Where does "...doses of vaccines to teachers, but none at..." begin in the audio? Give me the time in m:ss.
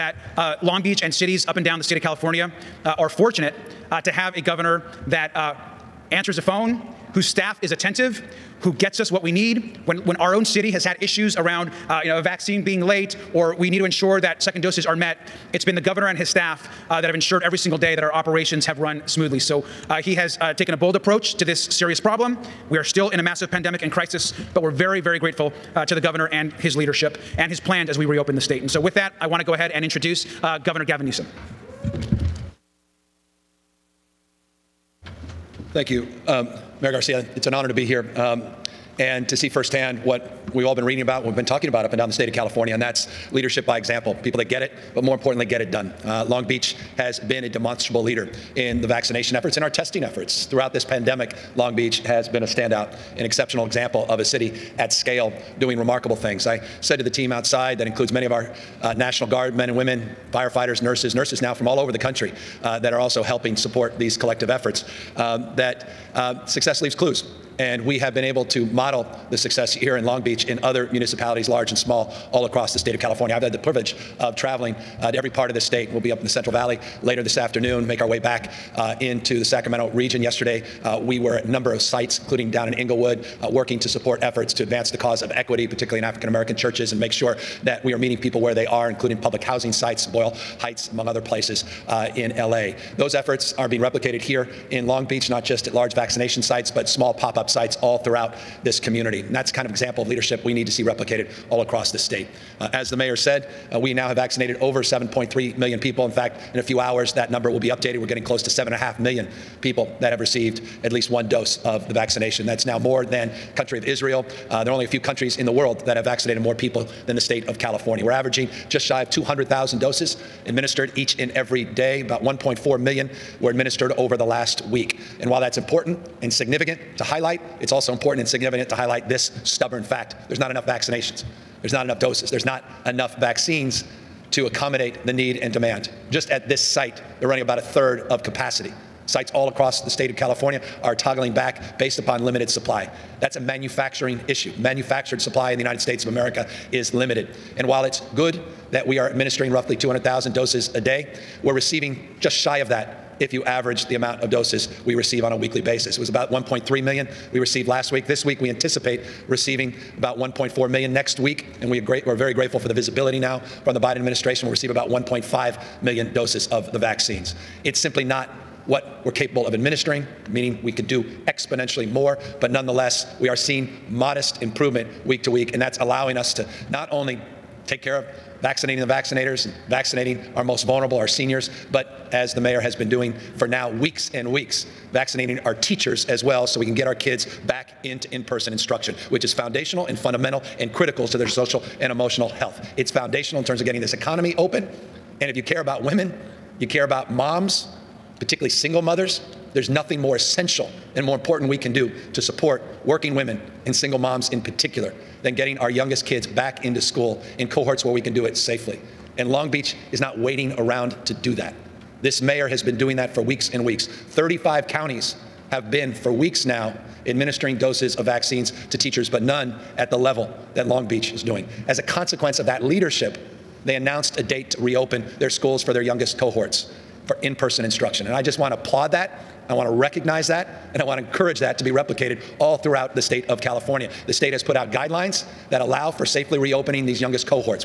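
3:37.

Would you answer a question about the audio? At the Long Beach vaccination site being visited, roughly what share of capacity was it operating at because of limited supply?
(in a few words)
a third.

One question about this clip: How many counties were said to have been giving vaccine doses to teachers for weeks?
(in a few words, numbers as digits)
35.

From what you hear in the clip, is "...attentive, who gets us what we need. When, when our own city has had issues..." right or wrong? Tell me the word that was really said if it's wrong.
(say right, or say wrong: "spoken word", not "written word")
right.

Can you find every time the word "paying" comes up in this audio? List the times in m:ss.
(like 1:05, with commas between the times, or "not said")
not said.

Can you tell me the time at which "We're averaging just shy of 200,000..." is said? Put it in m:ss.
1:58.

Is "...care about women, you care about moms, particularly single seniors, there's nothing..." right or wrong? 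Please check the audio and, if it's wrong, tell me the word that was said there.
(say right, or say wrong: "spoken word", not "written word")
wrong: "mothers", not "seniors".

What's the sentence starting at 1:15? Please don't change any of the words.
We'll be up in the Central Valley later this afternoon, make our way back uh, into the Sacramento region.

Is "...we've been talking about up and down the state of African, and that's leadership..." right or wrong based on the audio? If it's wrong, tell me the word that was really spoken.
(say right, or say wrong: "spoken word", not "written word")
wrong: "California", not "African".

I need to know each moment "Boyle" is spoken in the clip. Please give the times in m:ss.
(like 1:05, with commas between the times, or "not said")
1:30.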